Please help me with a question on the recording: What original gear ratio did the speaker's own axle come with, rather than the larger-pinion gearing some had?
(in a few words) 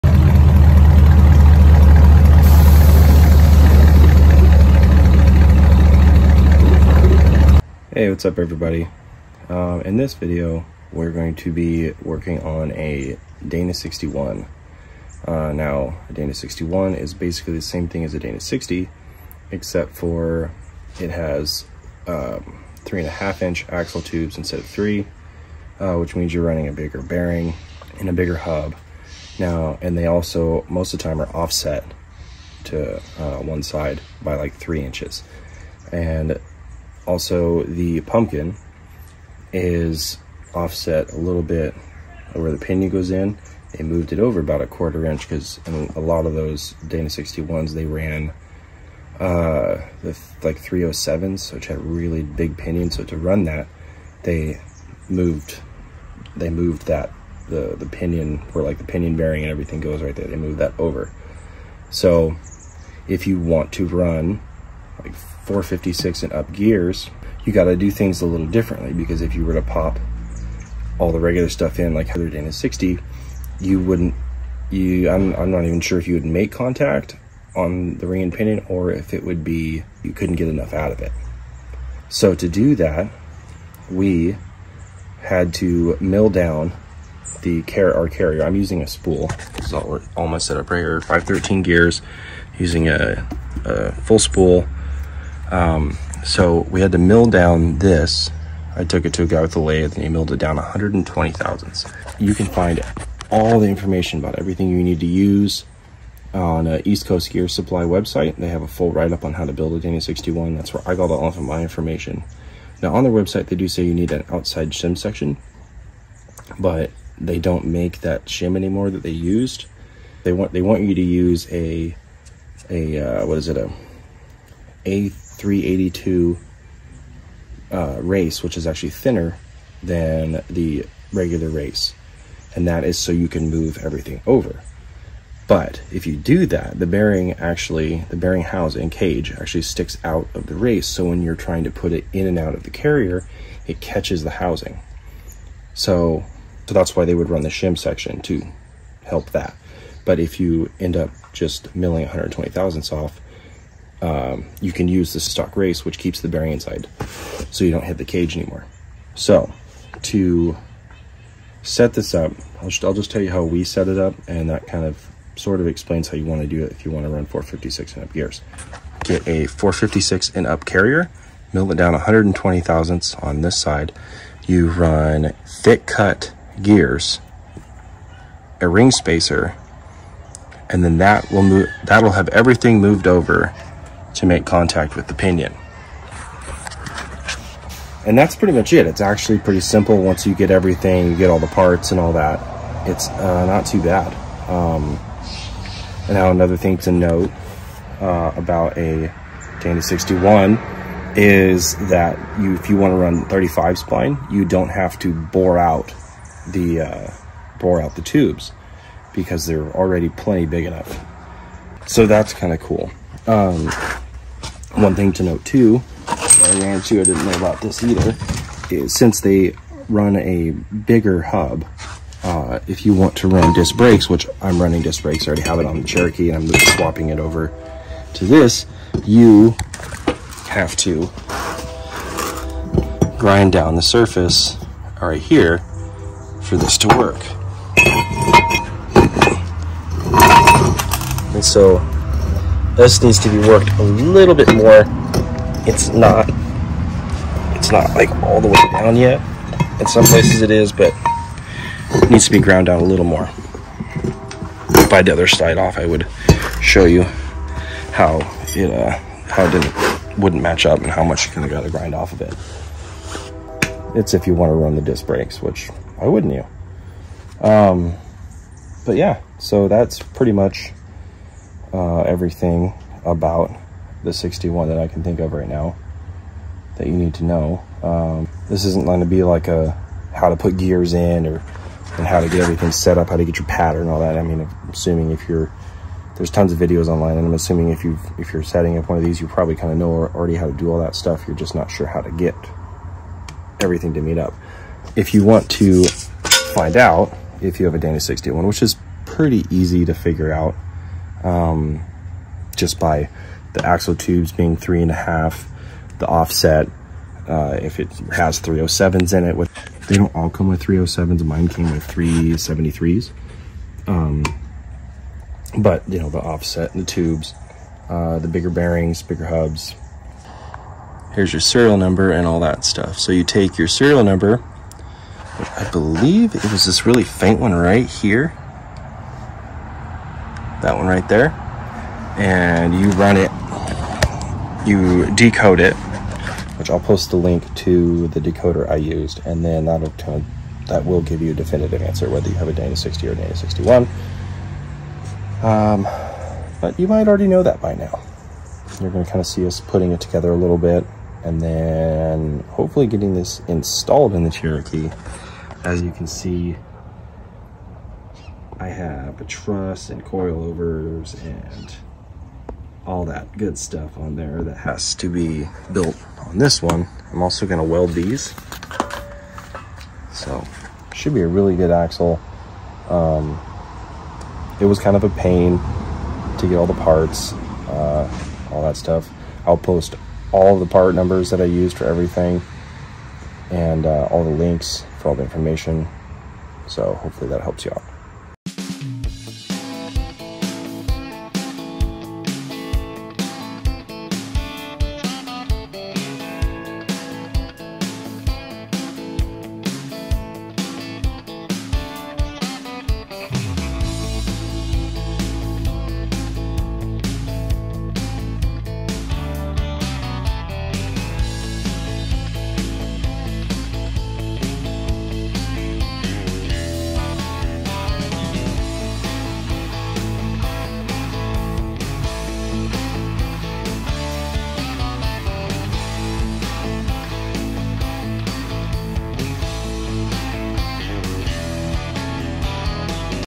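3.73.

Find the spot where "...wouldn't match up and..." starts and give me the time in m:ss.
4:20.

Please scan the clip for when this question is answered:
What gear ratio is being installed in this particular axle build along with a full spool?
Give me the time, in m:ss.
1:31.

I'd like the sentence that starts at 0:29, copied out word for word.
Now, and they also, most of the time, are offset to uh, one side by like three inches.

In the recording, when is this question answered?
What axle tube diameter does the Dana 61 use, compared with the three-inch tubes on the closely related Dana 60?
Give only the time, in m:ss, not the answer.
0:22.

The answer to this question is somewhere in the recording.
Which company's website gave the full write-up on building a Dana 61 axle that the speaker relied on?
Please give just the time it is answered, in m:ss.
1:46.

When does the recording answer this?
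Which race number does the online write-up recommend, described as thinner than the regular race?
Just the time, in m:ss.
2:05.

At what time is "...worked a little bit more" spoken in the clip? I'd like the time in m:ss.
4:03.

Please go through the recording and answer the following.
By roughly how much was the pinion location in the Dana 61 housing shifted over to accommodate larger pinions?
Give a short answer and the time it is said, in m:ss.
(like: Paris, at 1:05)
a quarter inch, at 0:44.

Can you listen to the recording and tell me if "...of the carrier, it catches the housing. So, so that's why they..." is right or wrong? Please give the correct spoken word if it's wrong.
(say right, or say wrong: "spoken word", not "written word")
right.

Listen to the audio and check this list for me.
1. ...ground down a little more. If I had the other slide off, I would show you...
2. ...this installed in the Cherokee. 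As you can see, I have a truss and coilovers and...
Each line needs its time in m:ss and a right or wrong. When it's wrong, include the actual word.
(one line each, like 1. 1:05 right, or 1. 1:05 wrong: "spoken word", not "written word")
1. 4:12 right
2. 5:53 right.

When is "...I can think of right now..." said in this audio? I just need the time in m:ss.
4:34.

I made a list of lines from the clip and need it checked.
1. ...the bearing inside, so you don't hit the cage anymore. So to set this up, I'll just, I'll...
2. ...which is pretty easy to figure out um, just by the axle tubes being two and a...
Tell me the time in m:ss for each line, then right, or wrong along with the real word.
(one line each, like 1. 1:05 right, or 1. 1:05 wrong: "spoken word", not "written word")
1. 2:36 right
2. 4:58 wrong: "three", not "two".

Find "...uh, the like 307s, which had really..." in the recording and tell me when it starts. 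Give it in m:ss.
0:49.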